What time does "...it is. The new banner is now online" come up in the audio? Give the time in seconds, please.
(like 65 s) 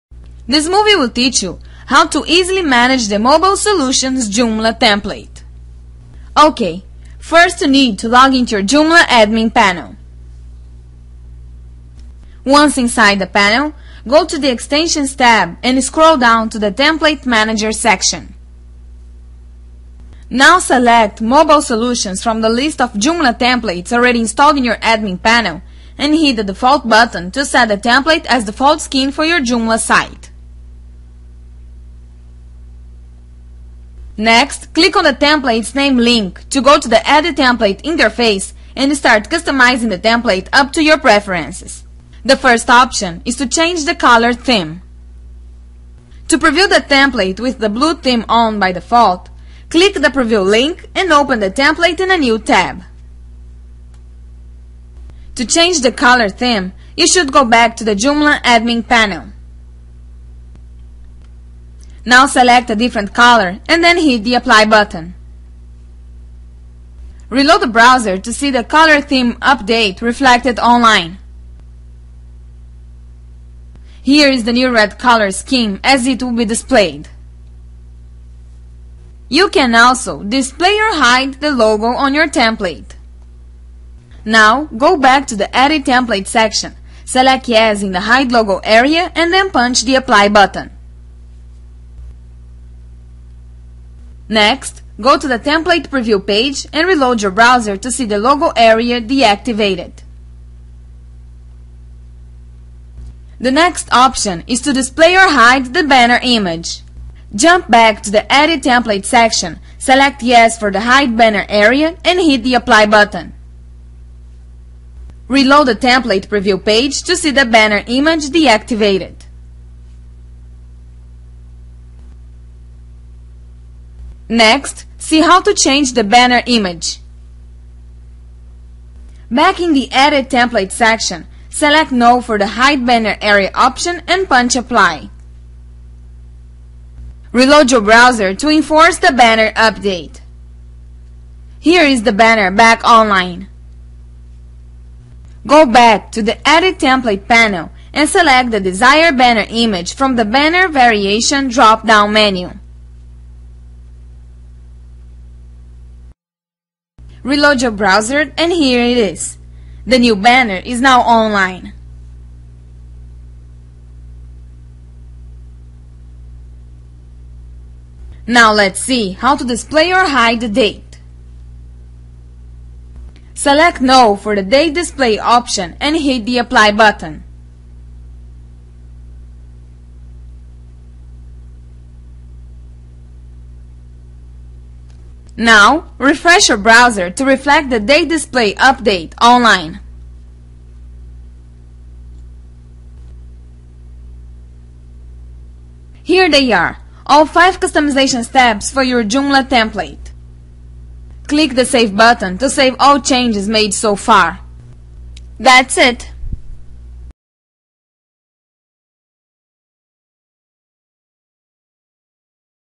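158 s.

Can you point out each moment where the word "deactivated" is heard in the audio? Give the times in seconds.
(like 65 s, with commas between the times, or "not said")
99 s, 118 s.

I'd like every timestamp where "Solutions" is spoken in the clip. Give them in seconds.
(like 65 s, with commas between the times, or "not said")
3 s, 21 s.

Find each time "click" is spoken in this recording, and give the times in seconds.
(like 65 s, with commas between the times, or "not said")
34 s, 49 s, 201 s.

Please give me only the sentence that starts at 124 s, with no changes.
Next, see how to change the banner image.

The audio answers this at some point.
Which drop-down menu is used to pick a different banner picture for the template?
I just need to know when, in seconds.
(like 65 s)
150 s.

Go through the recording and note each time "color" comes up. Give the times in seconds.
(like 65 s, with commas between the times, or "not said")
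43 s, 55 s, 63 s, 68 s, 74 s.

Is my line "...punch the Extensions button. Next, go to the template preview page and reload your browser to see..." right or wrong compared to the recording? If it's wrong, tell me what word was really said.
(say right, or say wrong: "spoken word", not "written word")
wrong: "Apply", not "Extensions".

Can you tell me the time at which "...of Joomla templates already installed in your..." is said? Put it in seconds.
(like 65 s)
22 s.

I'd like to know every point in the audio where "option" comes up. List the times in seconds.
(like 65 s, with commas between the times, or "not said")
42 s, 103 s, 133 s, 175 s.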